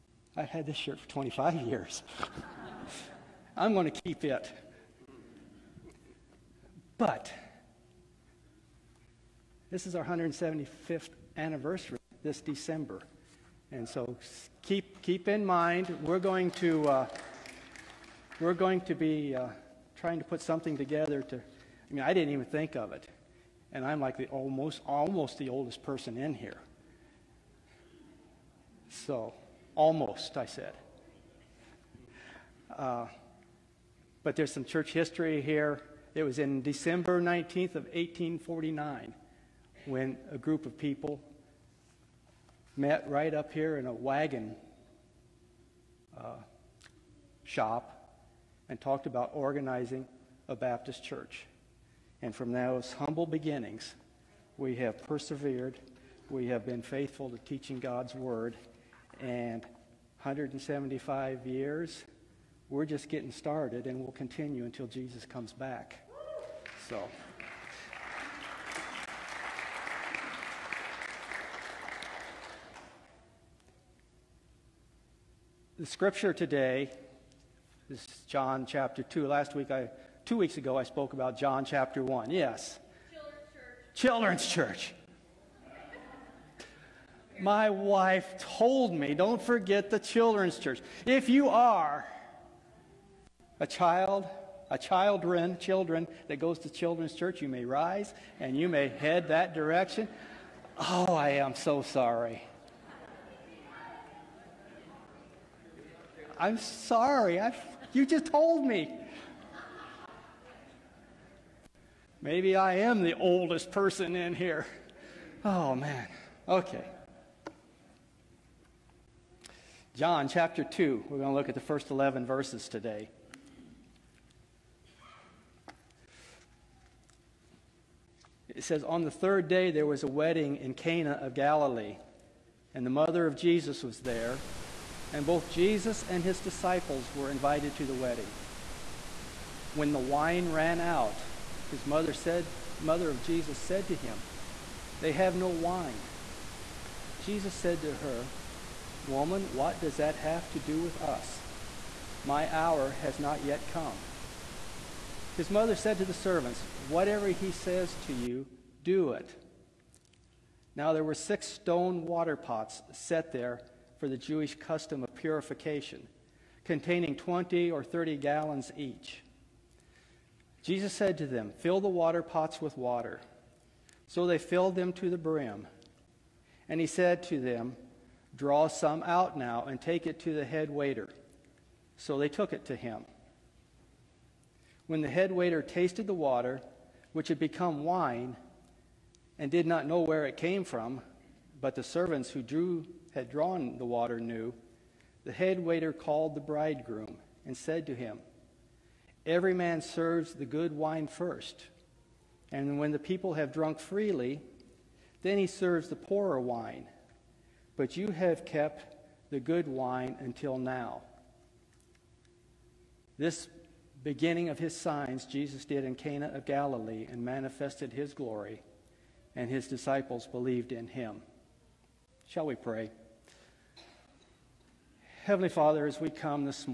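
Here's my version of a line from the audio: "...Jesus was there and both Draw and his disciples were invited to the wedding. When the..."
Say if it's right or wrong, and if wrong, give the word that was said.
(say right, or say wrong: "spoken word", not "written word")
wrong: "Jesus", not "Draw".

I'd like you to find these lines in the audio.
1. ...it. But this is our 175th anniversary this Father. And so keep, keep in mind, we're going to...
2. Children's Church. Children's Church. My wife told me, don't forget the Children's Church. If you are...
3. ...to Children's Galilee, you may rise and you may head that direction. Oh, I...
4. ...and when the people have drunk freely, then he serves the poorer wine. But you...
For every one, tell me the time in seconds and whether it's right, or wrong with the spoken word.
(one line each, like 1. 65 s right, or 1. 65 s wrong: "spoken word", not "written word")
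1. 4 s wrong: "December", not "Father"
2. 83 s right
3. 96 s wrong: "Church", not "Galilee"
4. 202 s right.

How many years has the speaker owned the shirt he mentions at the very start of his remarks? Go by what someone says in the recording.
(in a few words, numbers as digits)
25.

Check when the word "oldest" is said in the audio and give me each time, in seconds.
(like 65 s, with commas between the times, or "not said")
25 s, 113 s.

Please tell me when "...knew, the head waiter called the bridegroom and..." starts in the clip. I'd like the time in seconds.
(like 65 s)
194 s.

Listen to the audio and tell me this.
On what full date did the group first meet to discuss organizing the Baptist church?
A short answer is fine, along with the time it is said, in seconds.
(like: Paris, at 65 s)
December 19th of 1849, at 36 s.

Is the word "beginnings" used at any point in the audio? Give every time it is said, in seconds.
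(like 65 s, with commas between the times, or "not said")
53 s, 214 s.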